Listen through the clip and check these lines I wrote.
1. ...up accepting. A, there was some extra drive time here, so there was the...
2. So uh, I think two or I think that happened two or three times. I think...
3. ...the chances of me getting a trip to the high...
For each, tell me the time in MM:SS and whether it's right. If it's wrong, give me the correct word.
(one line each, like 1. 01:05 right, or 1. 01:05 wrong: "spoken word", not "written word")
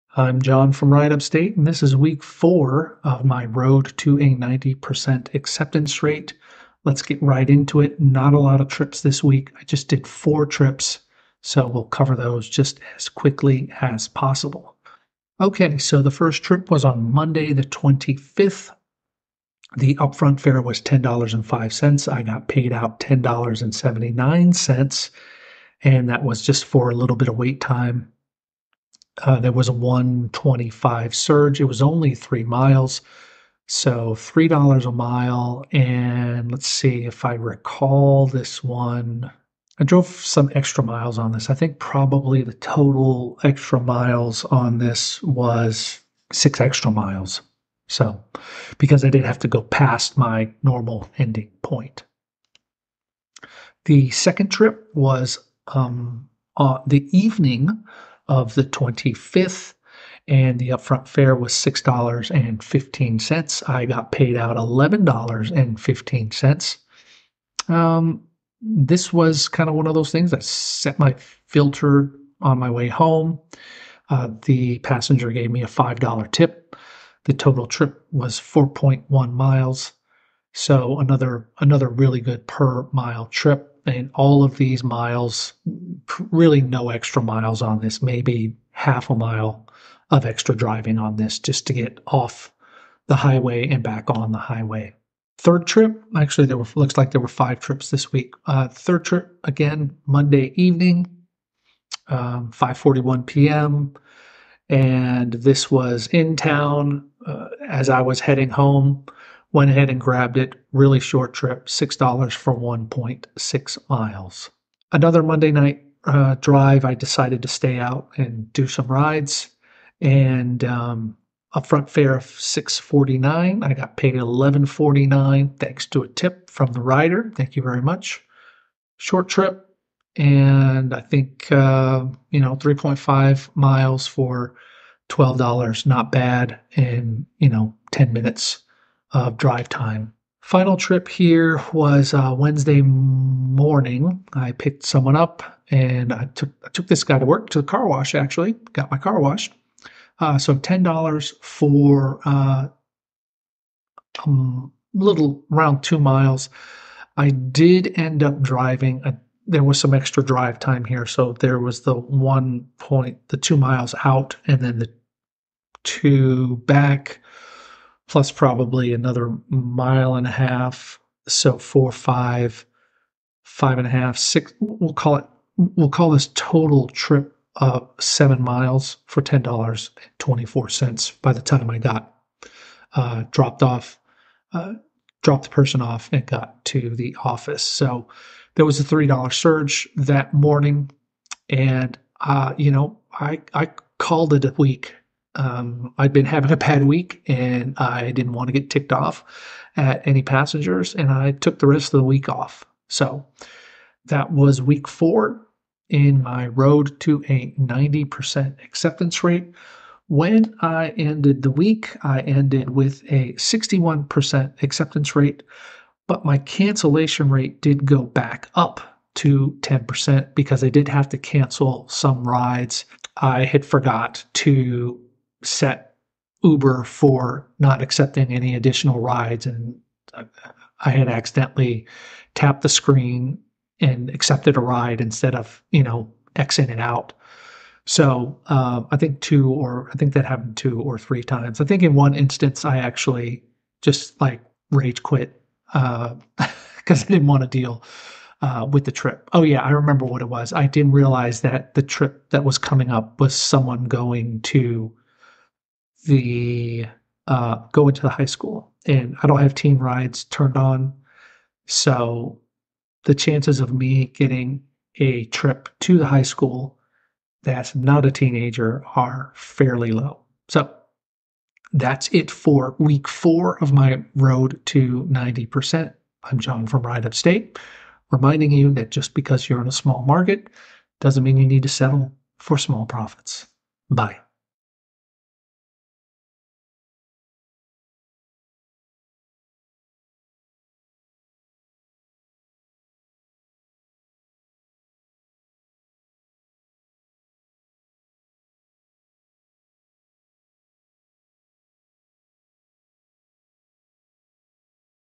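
1. 02:38 wrong: "driving", not "accepting"
2. 03:57 right
3. 04:23 right.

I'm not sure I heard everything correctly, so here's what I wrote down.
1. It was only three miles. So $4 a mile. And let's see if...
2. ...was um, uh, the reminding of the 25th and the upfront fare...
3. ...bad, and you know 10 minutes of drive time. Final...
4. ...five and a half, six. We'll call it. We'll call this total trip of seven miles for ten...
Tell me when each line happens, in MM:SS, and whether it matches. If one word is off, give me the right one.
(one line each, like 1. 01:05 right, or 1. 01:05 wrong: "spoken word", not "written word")
1. 00:31 wrong: "3", not "4"
2. 00:54 wrong: "evening", not "reminding"
3. 02:16 right
4. 02:53 right.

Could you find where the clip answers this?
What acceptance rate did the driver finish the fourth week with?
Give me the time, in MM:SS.
03:33.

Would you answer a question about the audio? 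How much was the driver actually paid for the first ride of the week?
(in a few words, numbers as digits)
$10.79.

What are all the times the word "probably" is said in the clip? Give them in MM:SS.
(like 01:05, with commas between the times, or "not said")
00:41, 02:48.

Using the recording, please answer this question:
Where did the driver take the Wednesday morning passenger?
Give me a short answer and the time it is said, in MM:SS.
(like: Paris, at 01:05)
The car wash, at 02:27.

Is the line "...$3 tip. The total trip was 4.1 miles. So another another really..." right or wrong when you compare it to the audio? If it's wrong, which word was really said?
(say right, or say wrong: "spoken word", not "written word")
wrong: "5", not "3".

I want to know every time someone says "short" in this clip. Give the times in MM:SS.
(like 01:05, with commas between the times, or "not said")
01:50, 02:08.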